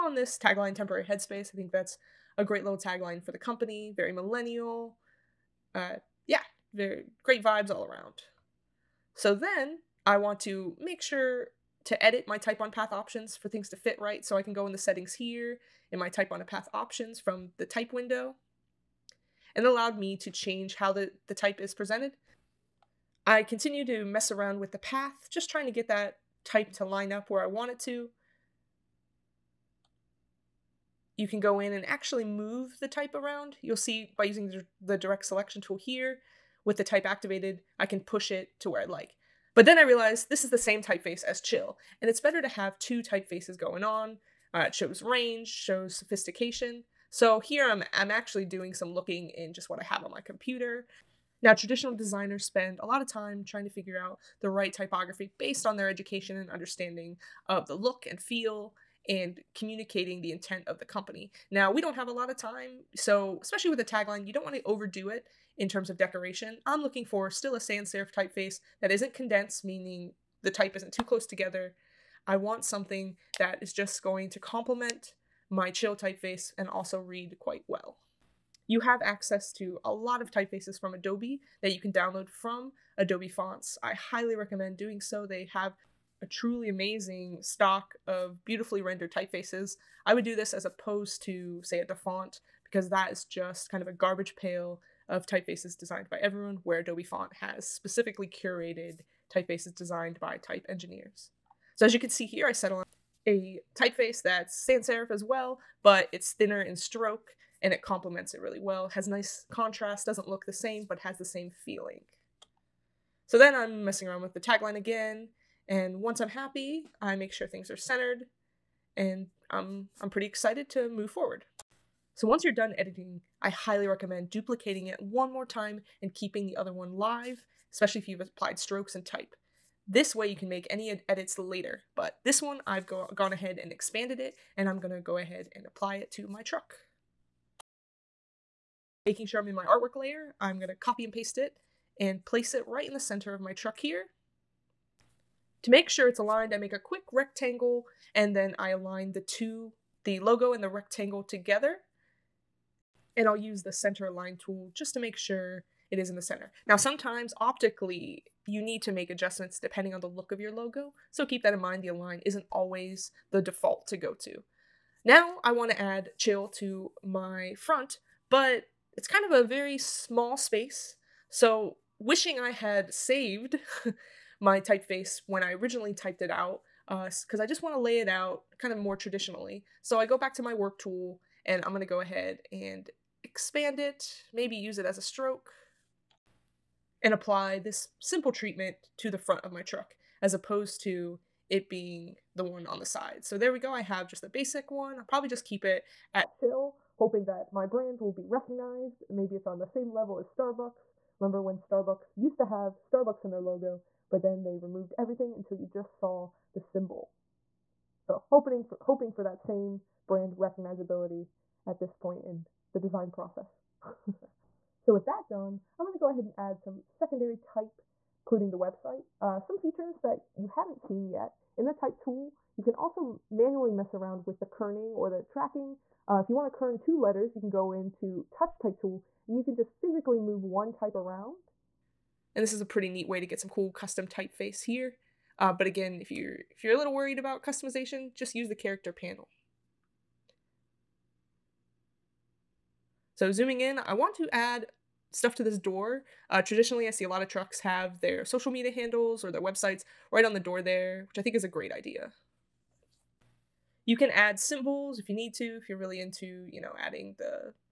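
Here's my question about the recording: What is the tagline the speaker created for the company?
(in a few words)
Temporary headspace.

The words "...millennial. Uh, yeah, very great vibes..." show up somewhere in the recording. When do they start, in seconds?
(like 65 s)
4 s.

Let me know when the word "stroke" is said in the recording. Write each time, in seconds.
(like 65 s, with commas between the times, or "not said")
106 s, 128 s, 185 s.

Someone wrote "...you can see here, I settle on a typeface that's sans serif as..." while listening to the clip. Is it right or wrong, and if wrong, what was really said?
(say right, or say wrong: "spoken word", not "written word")
right.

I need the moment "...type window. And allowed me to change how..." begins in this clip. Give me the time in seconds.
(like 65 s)
17 s.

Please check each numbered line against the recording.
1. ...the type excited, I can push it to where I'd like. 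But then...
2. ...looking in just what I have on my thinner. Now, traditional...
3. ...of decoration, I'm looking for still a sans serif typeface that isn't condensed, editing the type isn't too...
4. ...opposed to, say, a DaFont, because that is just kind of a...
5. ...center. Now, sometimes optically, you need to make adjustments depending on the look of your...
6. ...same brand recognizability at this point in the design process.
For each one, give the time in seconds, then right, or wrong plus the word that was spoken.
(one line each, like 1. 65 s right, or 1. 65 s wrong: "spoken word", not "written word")
1. 36 s wrong: "activated", not "excited"
2. 48 s wrong: "computer", not "thinner"
3. 65 s wrong: "meaning", not "editing"
4. 90 s right
5. 156 s right
6. 209 s right.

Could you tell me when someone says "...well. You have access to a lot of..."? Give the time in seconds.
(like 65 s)
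77 s.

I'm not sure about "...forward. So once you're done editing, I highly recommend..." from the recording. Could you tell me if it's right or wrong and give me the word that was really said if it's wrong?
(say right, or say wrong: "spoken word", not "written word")
right.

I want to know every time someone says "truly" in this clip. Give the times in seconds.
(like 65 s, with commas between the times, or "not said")
86 s.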